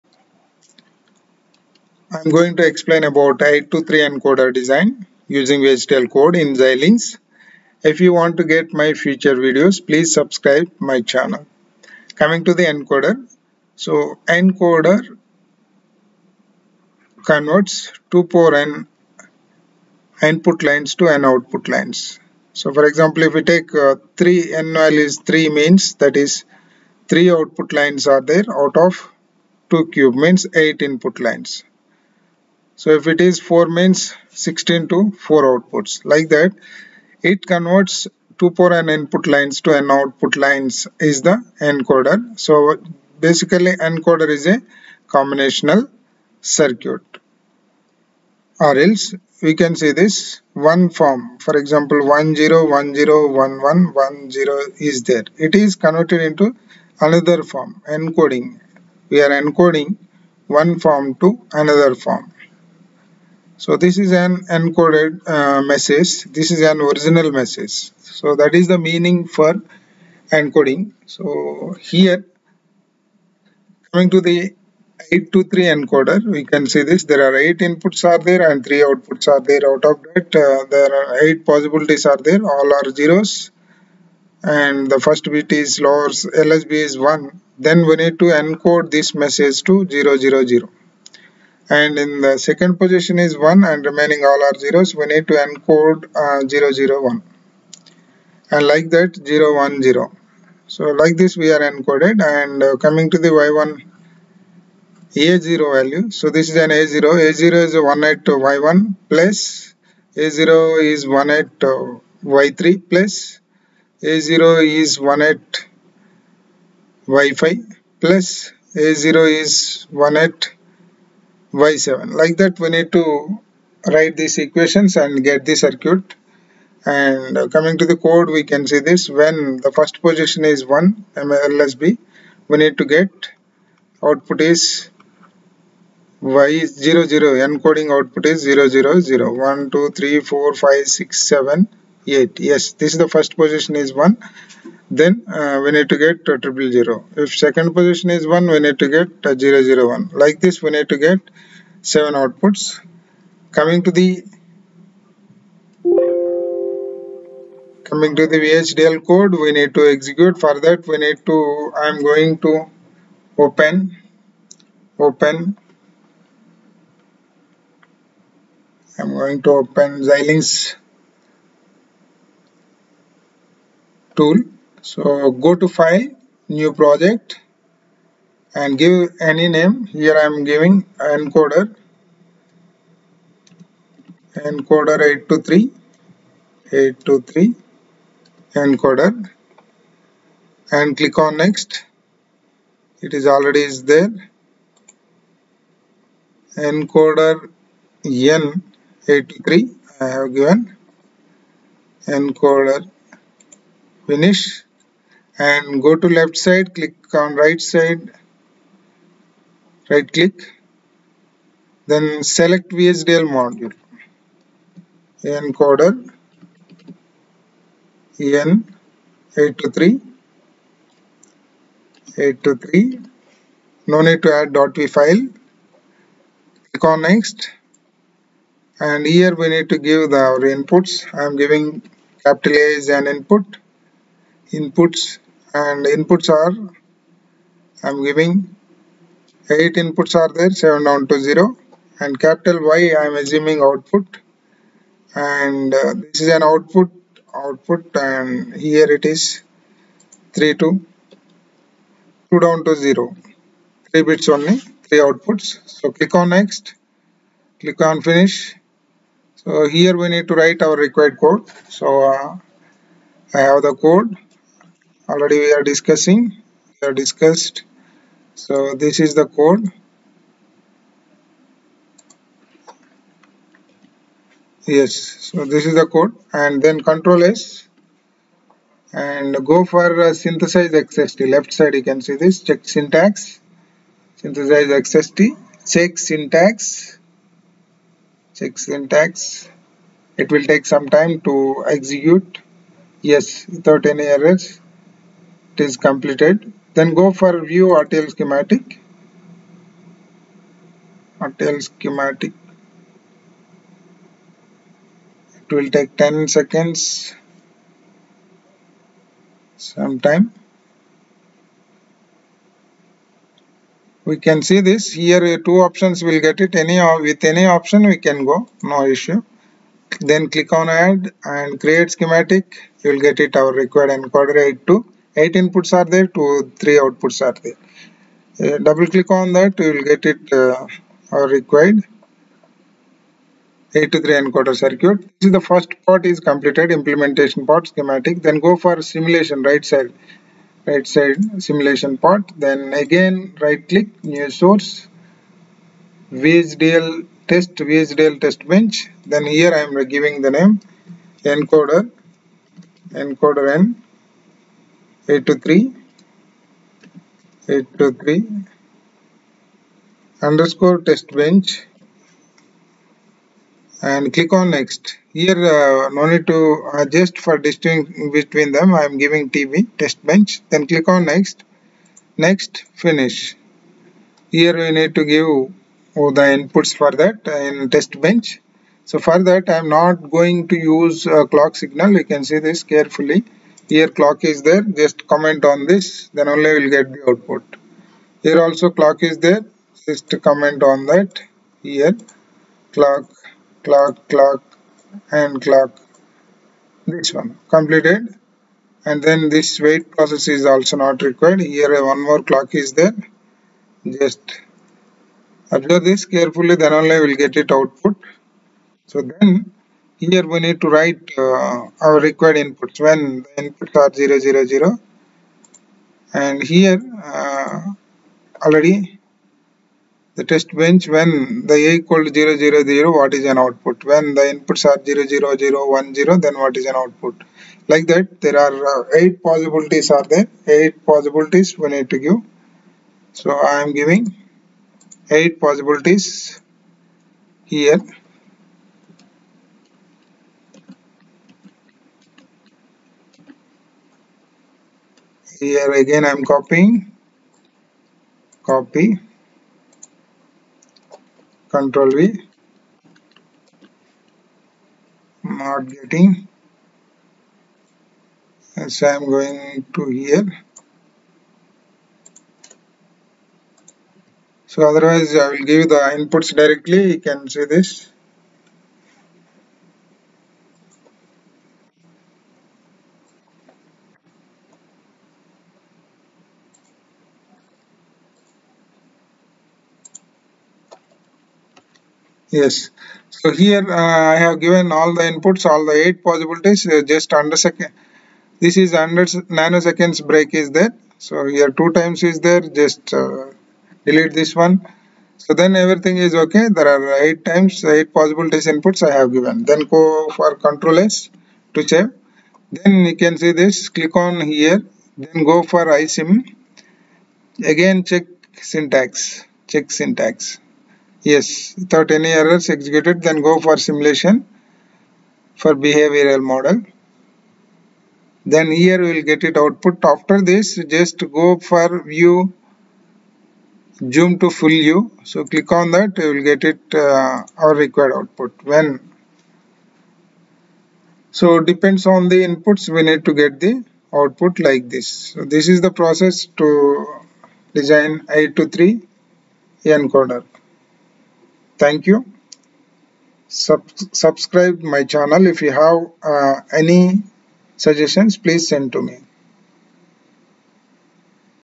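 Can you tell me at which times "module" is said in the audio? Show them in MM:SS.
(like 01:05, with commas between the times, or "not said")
03:33.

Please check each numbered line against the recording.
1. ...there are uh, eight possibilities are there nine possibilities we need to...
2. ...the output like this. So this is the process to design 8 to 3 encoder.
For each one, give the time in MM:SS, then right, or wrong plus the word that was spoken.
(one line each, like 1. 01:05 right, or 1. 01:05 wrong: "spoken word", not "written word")
1. 07:08 wrong: "eight", not "nine"
2. 08:53 right.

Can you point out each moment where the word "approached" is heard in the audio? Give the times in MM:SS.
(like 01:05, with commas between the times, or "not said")
not said.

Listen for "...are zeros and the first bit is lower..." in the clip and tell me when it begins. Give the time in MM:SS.
01:22.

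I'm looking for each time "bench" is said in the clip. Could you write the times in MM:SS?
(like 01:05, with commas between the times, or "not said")
05:48, 06:01, 06:10, 06:17, 07:00.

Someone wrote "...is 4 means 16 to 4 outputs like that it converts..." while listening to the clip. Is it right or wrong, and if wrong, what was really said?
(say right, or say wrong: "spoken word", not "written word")
right.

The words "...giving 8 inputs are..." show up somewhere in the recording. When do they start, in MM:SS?
03:58.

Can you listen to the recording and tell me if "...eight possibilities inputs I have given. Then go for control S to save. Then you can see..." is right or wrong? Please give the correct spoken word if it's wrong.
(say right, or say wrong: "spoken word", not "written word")
right.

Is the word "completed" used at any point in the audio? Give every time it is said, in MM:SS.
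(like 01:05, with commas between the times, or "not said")
04:55, 05:36, 06:37.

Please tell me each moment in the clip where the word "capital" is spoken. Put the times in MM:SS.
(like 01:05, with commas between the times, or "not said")
03:52, 04:02.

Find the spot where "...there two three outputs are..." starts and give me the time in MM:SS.
05:25.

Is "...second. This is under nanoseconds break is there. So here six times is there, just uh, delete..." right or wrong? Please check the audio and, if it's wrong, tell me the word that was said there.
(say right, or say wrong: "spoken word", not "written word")
wrong: "two", not "six".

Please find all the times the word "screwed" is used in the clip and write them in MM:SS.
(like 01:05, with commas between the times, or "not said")
not said.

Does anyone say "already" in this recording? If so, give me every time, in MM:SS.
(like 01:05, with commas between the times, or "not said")
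03:13, 04:25, 06:58.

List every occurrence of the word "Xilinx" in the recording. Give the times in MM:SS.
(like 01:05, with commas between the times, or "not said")
00:06, 02:50.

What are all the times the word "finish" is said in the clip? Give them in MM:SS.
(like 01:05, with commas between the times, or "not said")
03:24, 04:18, 06:12.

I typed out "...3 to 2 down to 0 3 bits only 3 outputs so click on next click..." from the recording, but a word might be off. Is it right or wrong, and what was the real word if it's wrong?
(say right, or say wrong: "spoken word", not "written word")
right.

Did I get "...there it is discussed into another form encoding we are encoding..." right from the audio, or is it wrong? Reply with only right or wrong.
wrong.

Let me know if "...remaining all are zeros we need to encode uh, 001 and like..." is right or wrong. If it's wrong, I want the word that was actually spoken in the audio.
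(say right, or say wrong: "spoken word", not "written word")
right.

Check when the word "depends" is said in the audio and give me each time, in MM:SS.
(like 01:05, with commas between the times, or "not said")
08:51.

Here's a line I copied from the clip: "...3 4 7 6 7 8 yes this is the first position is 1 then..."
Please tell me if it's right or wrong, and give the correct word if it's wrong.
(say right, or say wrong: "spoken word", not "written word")
wrong: "5", not "7".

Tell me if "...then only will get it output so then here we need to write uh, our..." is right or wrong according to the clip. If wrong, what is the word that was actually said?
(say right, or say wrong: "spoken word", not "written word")
right.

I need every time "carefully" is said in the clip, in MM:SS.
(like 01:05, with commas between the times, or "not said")
06:22, 06:46.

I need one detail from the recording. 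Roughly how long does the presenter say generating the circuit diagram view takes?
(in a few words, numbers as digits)
10 seconds.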